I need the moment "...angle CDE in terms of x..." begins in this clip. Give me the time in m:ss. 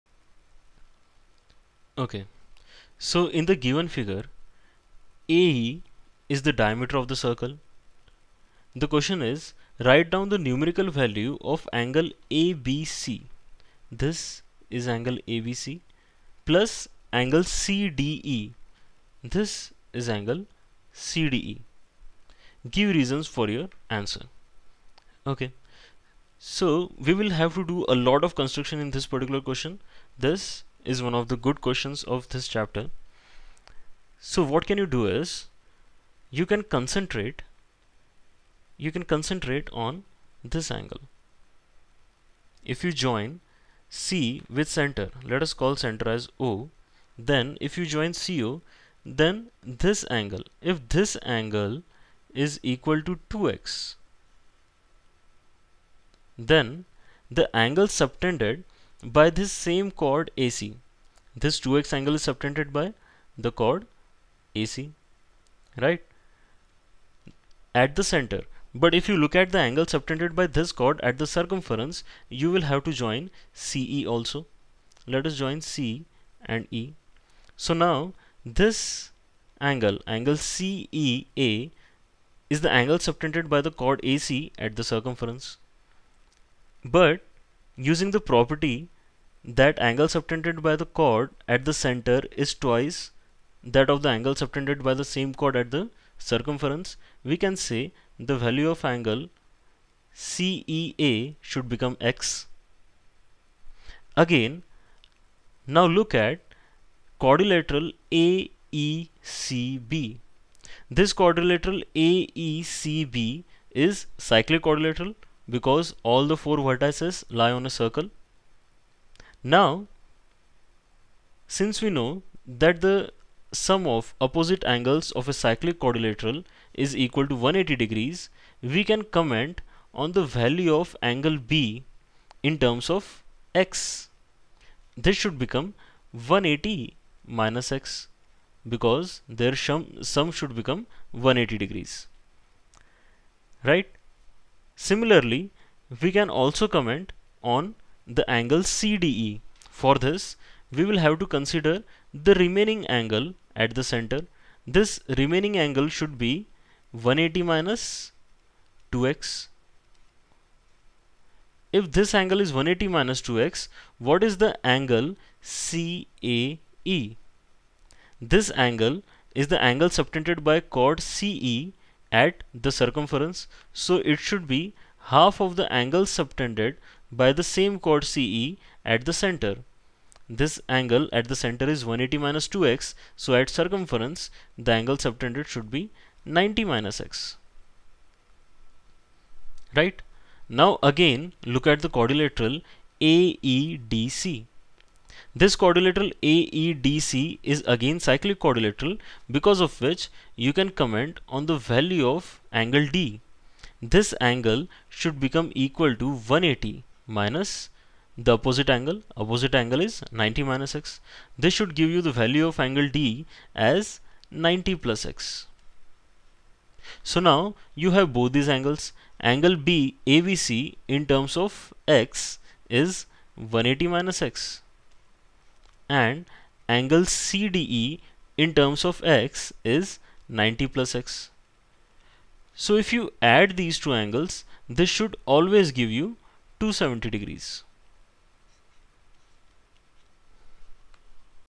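3:46.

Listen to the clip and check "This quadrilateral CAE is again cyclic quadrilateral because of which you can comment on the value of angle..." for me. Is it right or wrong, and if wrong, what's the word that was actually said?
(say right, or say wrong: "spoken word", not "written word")
wrong: "AEDC", not "CAE".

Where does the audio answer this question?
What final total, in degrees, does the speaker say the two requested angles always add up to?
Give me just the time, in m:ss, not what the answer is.
3:56.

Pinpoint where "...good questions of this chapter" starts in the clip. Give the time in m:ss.
0:31.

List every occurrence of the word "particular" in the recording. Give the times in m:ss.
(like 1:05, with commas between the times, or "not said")
0:29.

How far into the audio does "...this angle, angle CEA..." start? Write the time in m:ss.
1:18.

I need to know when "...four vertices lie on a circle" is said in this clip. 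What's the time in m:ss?
1:56.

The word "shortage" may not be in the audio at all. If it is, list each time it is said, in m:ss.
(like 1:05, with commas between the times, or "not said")
not said.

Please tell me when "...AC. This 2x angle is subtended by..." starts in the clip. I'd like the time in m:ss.
1:00.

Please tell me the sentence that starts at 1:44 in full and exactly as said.
Again, now look at quadrilateral AECB.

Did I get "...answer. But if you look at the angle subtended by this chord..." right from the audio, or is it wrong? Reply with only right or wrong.
wrong.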